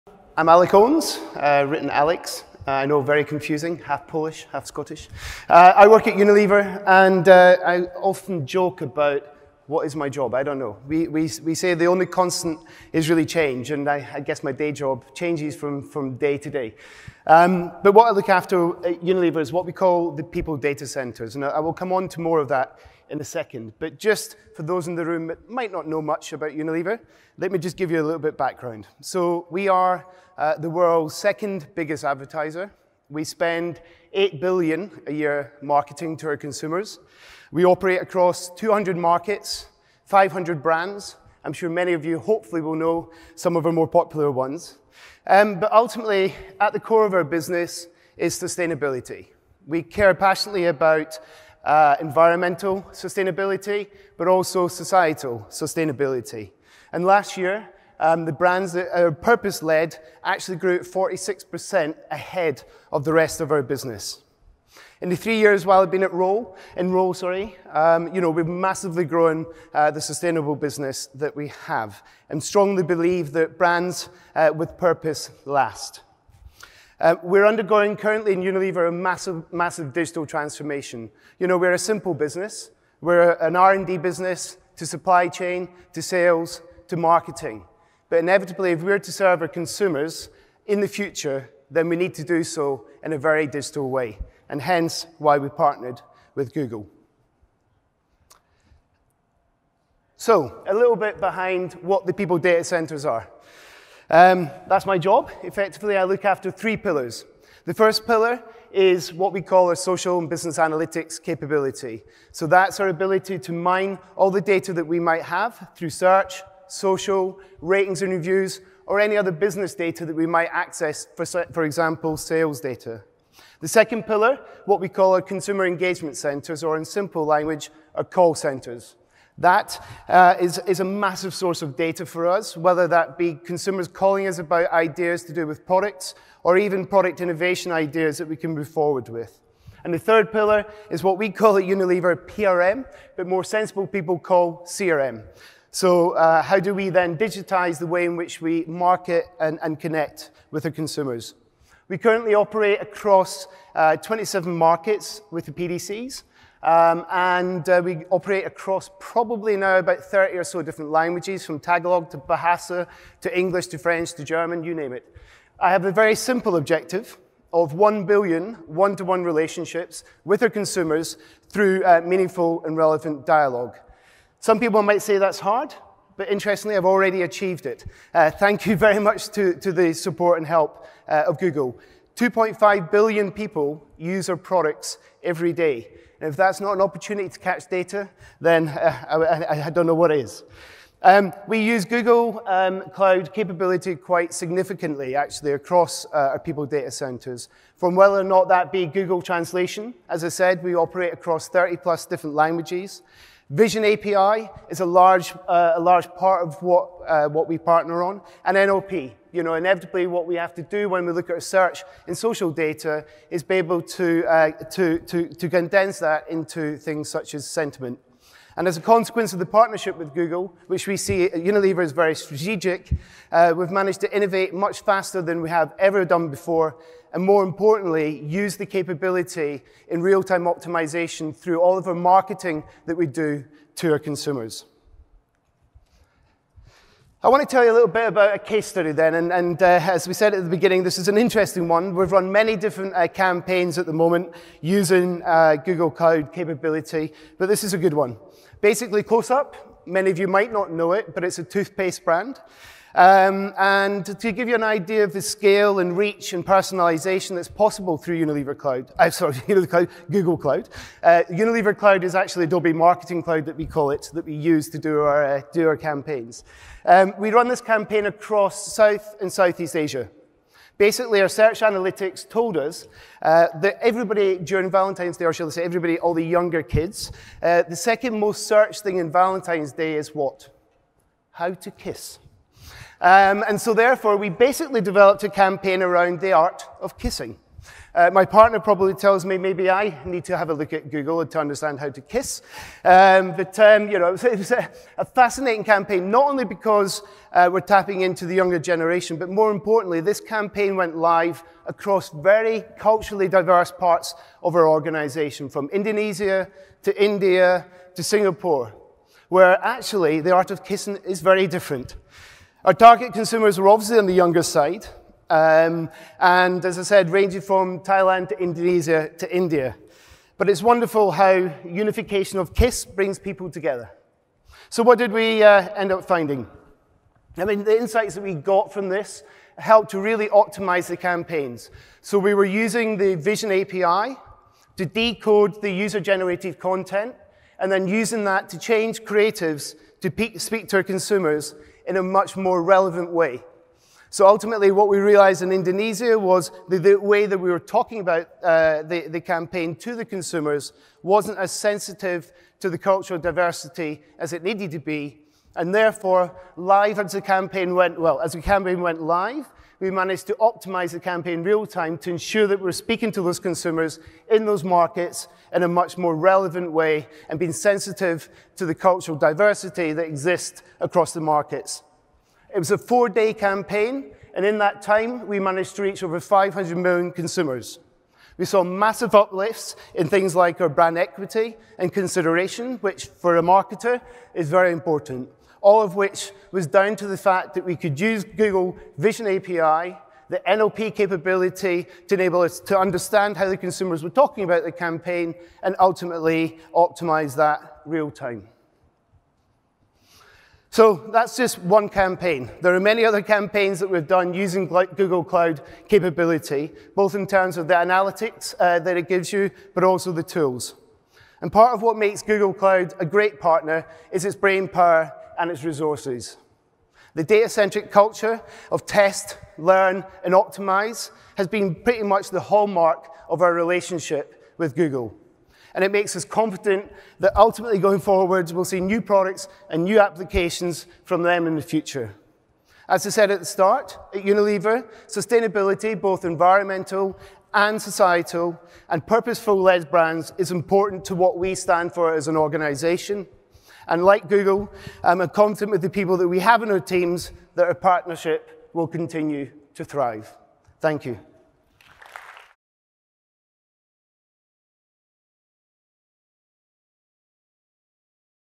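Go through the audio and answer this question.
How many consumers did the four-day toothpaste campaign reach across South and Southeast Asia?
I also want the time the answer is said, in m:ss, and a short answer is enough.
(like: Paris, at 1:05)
over 500 million, at 6:16.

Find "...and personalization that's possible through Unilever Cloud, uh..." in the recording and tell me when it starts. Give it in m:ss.
4:16.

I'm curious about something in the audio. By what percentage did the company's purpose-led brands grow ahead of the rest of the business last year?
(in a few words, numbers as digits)
46%.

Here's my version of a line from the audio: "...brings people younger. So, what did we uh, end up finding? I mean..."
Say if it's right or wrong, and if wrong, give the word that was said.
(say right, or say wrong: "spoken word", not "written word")
wrong: "together", not "younger".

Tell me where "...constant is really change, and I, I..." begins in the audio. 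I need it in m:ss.
0:12.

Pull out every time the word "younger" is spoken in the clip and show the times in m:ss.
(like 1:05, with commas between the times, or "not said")
4:36, 4:58, 5:14.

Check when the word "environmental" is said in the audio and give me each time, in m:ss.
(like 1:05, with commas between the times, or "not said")
0:51, 7:16.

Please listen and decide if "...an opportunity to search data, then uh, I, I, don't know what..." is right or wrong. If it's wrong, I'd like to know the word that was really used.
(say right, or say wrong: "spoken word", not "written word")
wrong: "catch", not "search".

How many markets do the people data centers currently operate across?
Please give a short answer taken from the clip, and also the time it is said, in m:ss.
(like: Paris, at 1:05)
27, at 2:33.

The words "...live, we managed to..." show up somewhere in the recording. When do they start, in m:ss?
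5:59.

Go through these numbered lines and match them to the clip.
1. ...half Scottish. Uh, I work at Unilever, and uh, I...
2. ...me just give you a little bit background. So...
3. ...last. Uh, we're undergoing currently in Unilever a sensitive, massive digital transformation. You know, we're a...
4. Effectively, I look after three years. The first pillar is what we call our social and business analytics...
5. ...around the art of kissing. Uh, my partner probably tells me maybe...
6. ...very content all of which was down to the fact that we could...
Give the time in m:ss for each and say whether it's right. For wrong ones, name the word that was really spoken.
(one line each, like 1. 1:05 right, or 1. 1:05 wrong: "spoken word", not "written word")
1. 0:04 right
2. 0:27 right
3. 1:15 wrong: "massive", not "sensitive"
4. 1:45 wrong: "pillars", not "years"
5. 4:45 right
6. 6:24 wrong: "important", not "content".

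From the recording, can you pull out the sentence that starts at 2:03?
The second pillar, what we call our consumer engagement centers, or in simple language, our call centers.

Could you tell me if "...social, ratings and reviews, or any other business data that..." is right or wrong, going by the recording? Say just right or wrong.
right.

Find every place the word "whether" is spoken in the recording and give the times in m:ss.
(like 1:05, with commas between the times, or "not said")
2:12, 3:17.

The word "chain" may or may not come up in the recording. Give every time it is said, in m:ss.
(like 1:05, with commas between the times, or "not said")
1:25.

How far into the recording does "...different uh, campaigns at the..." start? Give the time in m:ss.
4:02.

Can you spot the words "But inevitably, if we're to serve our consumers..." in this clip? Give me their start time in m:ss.
1:28.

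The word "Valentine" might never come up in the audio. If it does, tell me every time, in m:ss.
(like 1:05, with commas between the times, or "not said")
4:34, 4:39.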